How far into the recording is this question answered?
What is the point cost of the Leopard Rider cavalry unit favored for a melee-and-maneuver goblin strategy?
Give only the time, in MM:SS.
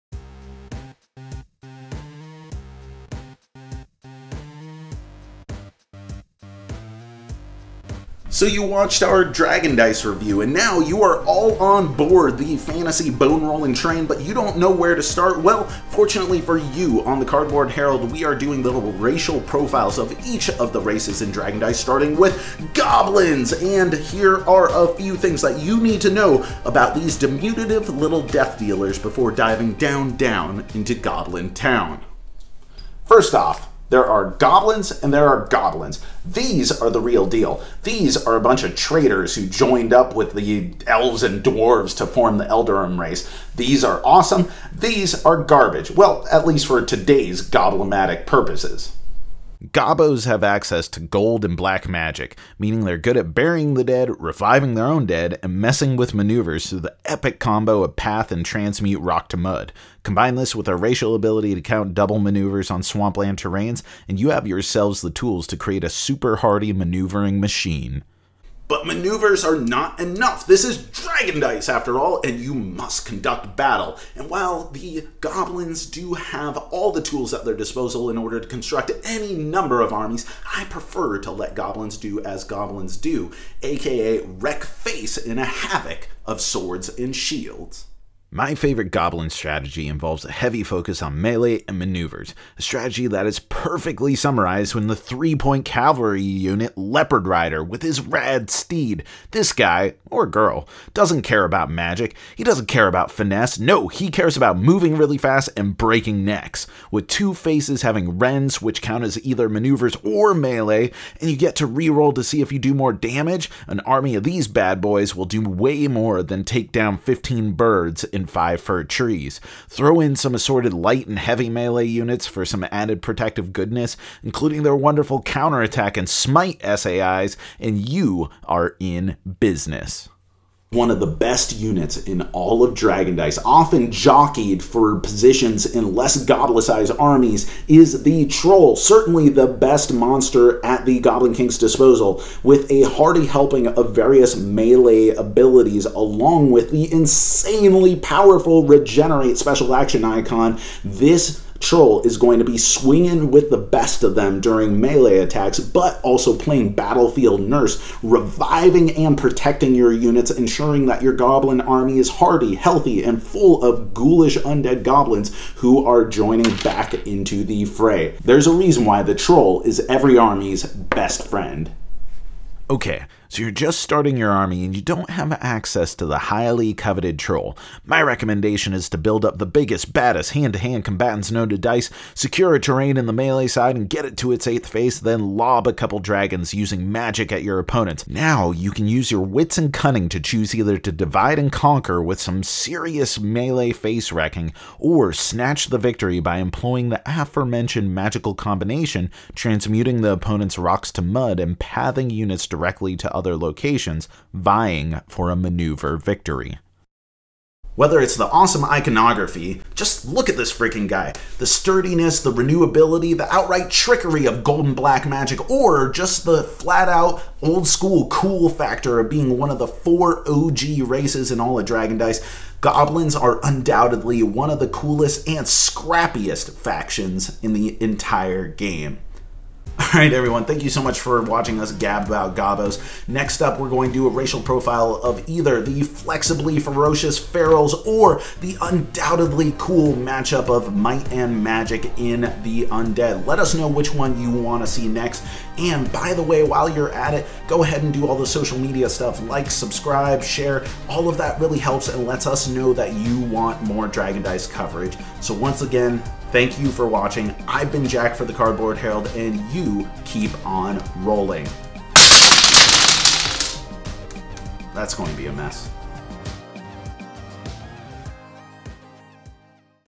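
01:34.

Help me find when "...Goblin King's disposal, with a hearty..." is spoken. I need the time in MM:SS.
02:21.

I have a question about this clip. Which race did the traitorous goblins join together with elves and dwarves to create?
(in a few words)
Eldarim.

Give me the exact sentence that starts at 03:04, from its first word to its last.
then lob a couple dragons using magic at your opponent.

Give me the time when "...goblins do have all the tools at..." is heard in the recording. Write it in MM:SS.
01:15.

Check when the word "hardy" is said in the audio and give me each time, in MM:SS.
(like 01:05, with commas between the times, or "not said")
01:06, 02:42.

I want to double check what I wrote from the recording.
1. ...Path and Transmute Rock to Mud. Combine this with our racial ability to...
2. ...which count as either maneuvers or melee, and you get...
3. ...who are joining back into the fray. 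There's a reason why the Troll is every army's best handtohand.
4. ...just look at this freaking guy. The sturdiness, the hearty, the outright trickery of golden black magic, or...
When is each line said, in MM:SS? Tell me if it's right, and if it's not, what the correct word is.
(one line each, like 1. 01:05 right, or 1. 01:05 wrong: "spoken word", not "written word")
1. 00:57 right
2. 01:48 right
3. 02:45 wrong: "friend", not "handtohand"
4. 03:29 wrong: "renewability", not "hearty".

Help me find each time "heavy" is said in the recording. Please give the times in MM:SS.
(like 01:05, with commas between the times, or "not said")
01:30, 02:01.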